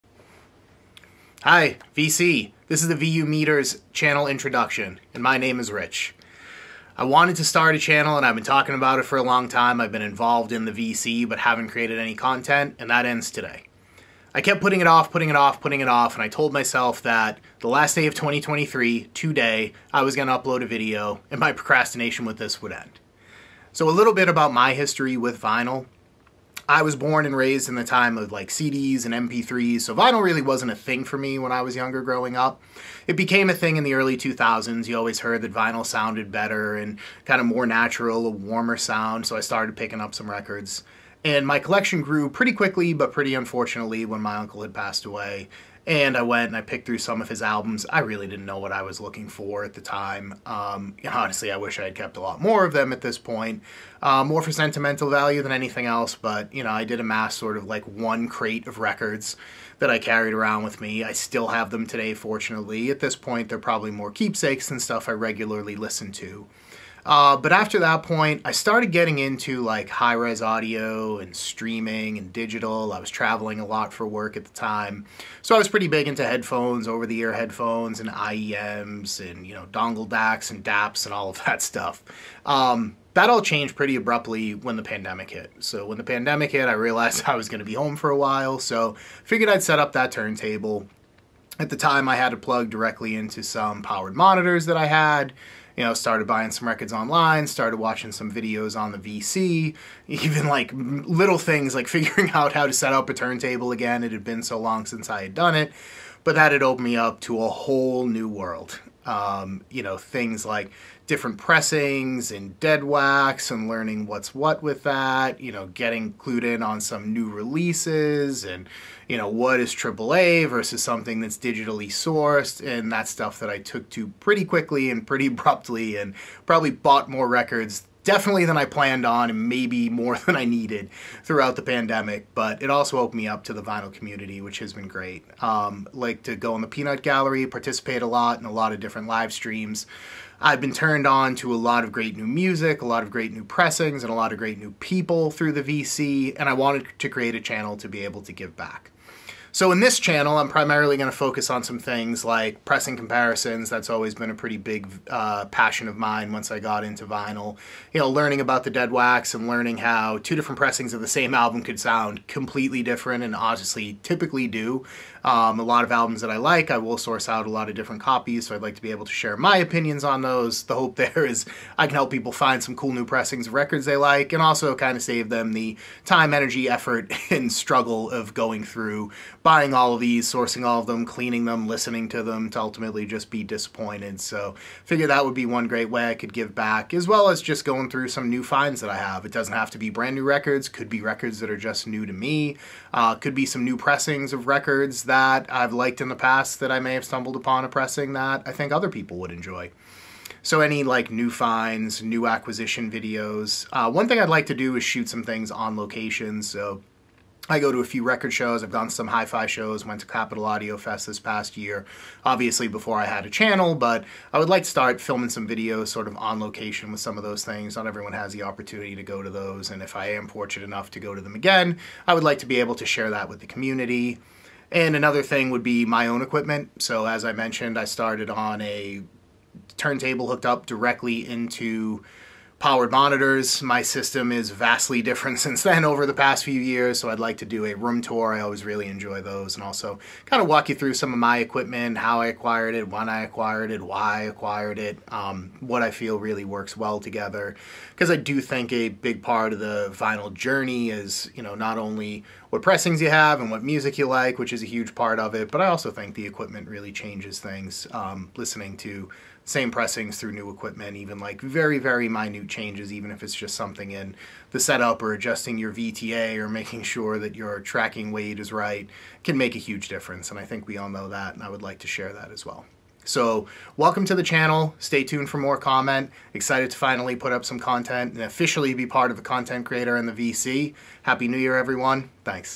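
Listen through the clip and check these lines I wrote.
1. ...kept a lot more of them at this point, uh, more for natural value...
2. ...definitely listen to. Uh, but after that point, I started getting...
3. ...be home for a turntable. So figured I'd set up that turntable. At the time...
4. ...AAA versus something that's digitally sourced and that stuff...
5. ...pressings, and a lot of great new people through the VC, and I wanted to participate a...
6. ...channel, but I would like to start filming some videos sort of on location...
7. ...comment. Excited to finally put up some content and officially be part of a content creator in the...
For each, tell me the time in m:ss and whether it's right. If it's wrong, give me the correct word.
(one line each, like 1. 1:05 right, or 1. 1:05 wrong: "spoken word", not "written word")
1. 0:51 wrong: "sentimental", not "natural"
2. 1:05 wrong: "regularly", not "definitely"
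3. 1:27 wrong: "while", not "turntable"
4. 1:59 right
5. 2:23 wrong: "create", not "participate"
6. 3:33 right
7. 4:35 right.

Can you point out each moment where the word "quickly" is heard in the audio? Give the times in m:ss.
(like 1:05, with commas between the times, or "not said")
0:42, 2:04.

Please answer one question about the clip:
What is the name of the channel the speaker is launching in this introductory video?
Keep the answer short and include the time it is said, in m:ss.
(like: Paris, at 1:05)
VU Meters, at 0:02.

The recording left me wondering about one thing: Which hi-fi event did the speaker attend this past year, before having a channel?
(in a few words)
Capital Audio Fest.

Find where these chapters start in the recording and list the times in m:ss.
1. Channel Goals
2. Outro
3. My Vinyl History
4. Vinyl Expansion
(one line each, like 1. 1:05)
1. 2:29
2. 4:34
3. 0:26
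4. 1:26.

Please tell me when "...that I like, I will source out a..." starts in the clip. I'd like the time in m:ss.
2:46.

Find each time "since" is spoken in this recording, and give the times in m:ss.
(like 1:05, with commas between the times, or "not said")
1:44, 3:55.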